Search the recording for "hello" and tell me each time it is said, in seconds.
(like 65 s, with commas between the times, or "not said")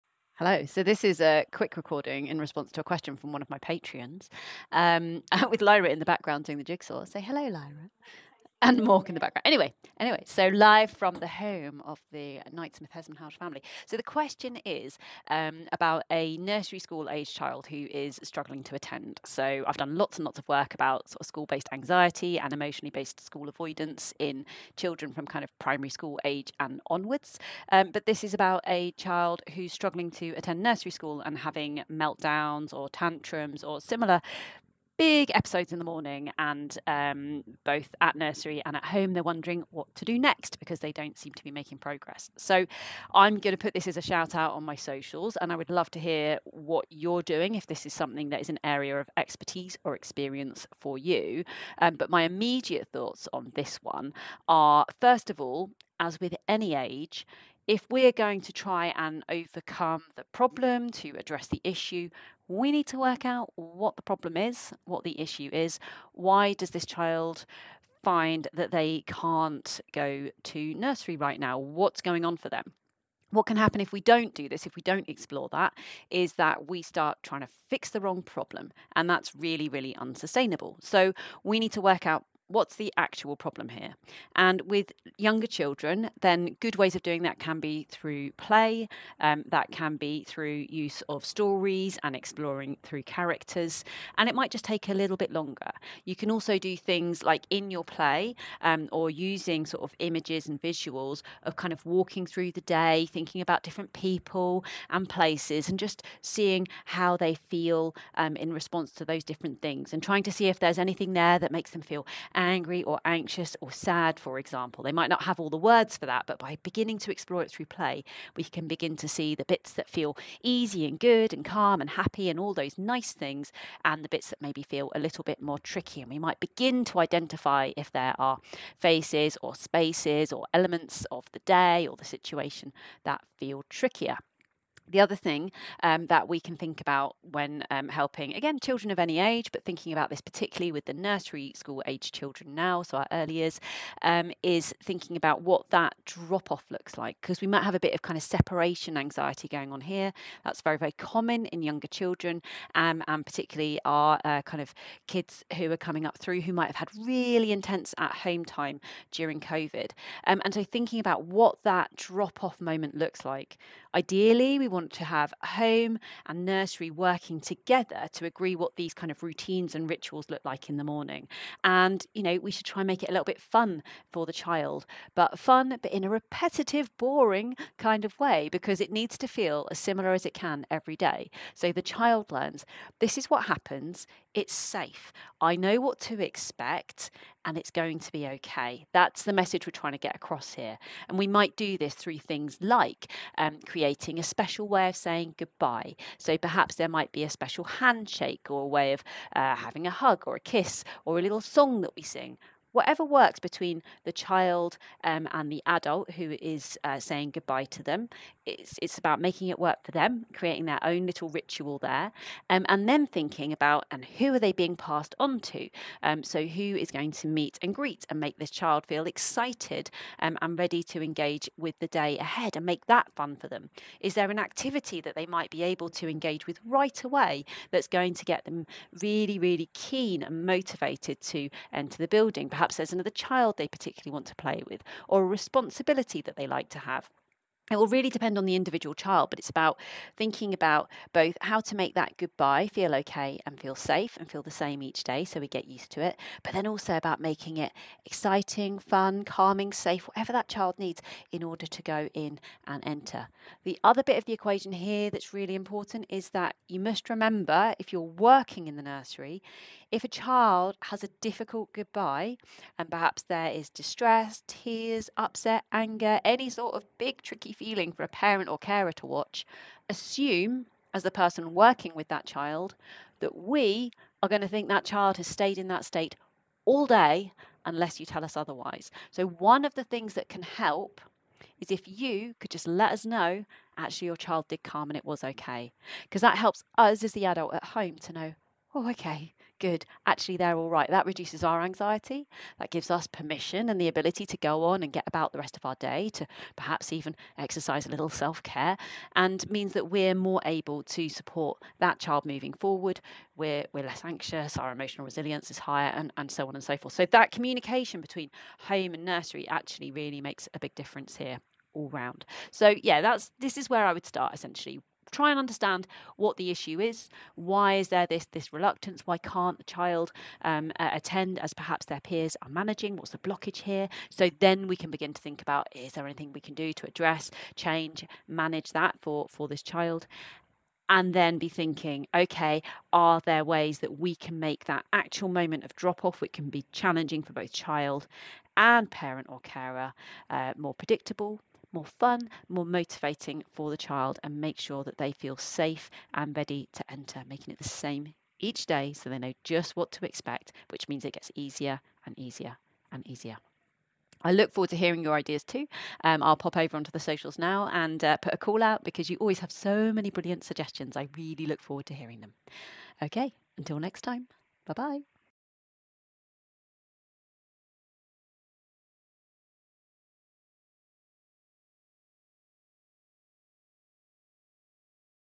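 0 s, 7 s.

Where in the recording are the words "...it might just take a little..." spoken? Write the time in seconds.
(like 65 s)
94 s.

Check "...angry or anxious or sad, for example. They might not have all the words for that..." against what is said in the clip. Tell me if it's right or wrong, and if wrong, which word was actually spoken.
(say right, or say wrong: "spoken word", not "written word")
right.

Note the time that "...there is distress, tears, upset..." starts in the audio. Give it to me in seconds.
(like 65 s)
263 s.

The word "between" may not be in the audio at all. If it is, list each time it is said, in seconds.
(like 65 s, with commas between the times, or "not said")
203 s, 308 s.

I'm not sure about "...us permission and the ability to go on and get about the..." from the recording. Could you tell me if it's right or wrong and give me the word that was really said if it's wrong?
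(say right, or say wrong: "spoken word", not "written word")
right.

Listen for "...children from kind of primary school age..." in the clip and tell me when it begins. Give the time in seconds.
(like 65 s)
24 s.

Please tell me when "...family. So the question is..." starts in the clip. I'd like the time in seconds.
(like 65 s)
13 s.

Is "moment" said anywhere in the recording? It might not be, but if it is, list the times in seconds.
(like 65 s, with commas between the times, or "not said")
162 s, 335 s.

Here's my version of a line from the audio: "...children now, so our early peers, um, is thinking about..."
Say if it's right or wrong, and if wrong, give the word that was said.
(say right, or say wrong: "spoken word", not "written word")
wrong: "years", not "peers".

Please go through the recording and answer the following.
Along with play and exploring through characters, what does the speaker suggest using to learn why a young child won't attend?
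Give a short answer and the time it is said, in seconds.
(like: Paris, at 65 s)
Stories, at 91 s.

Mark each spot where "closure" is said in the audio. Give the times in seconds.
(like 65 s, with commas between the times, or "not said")
not said.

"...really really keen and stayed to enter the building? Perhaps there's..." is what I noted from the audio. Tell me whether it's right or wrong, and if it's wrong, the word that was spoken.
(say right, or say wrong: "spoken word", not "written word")
wrong: "motivated", not "stayed".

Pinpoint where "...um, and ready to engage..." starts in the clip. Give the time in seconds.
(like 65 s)
220 s.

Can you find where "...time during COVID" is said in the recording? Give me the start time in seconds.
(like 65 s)
158 s.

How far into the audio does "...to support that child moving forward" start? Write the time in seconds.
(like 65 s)
300 s.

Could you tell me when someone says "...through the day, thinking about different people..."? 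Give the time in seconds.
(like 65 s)
102 s.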